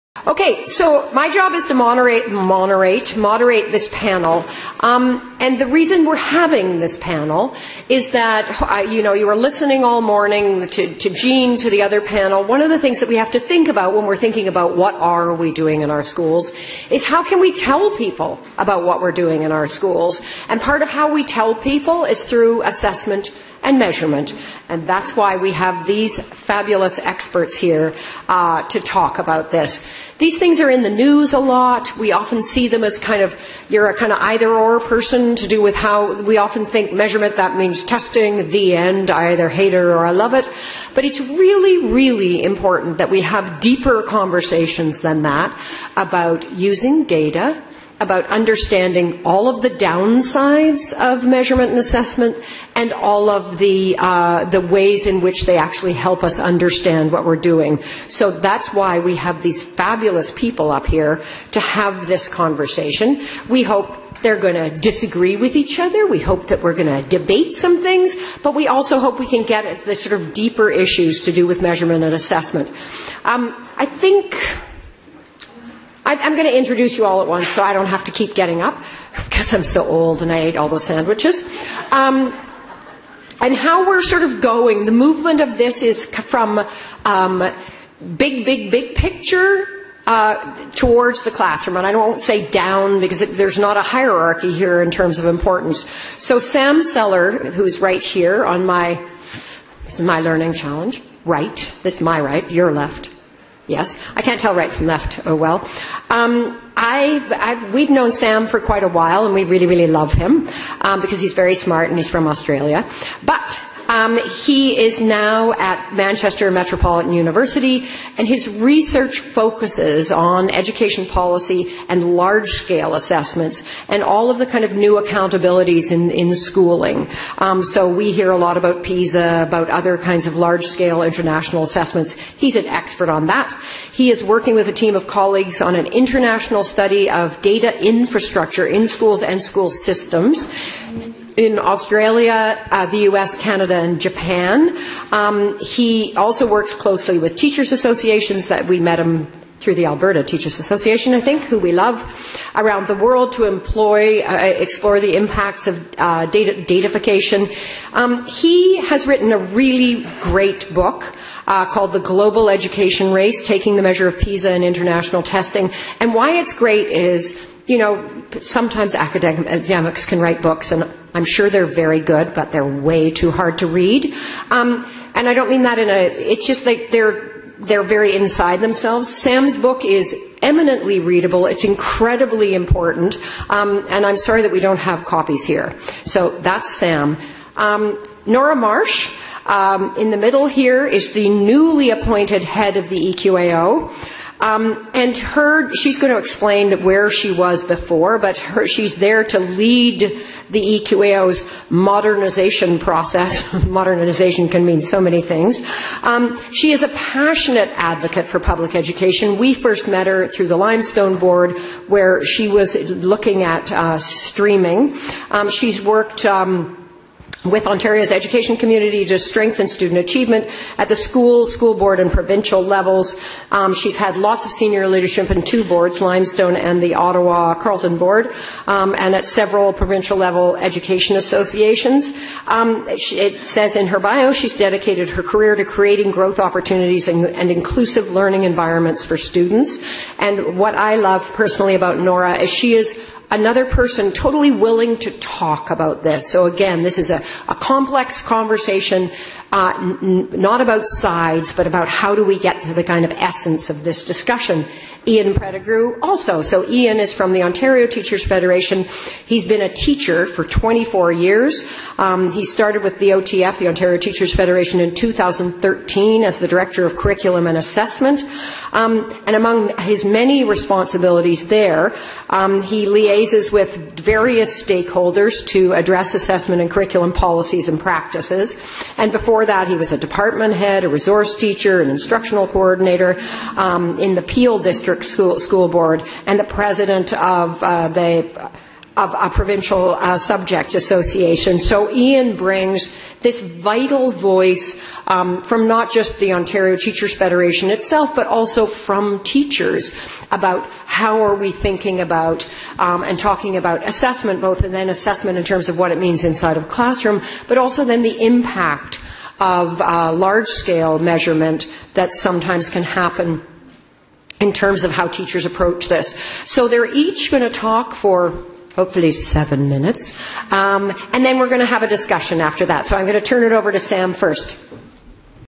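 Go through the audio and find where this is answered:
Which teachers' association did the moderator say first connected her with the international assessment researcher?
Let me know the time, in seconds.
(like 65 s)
149 s.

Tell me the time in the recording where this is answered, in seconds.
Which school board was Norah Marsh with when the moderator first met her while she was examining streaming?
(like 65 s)
210 s.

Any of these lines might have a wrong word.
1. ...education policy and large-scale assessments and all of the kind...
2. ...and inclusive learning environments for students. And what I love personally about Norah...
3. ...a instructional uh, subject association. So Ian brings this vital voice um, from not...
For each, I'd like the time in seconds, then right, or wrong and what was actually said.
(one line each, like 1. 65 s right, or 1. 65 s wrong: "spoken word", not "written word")
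1. 120 s right
2. 237 s right
3. 289 s wrong: "provincial", not "instructional".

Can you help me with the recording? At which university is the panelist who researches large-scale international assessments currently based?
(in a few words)
Manchester Metropolitan University.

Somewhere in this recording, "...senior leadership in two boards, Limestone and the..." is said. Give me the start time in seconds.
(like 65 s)
224 s.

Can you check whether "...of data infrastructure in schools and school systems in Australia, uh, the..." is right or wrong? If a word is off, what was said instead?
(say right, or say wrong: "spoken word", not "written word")
right.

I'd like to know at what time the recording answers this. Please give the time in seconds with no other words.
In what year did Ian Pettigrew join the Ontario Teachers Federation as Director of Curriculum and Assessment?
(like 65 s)
264 s.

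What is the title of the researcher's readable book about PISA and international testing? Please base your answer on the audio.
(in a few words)
The Global Education Race.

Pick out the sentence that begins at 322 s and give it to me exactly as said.
So I'm going to turn it over to Sam first.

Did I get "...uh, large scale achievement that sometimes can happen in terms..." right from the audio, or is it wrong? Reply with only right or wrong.
wrong.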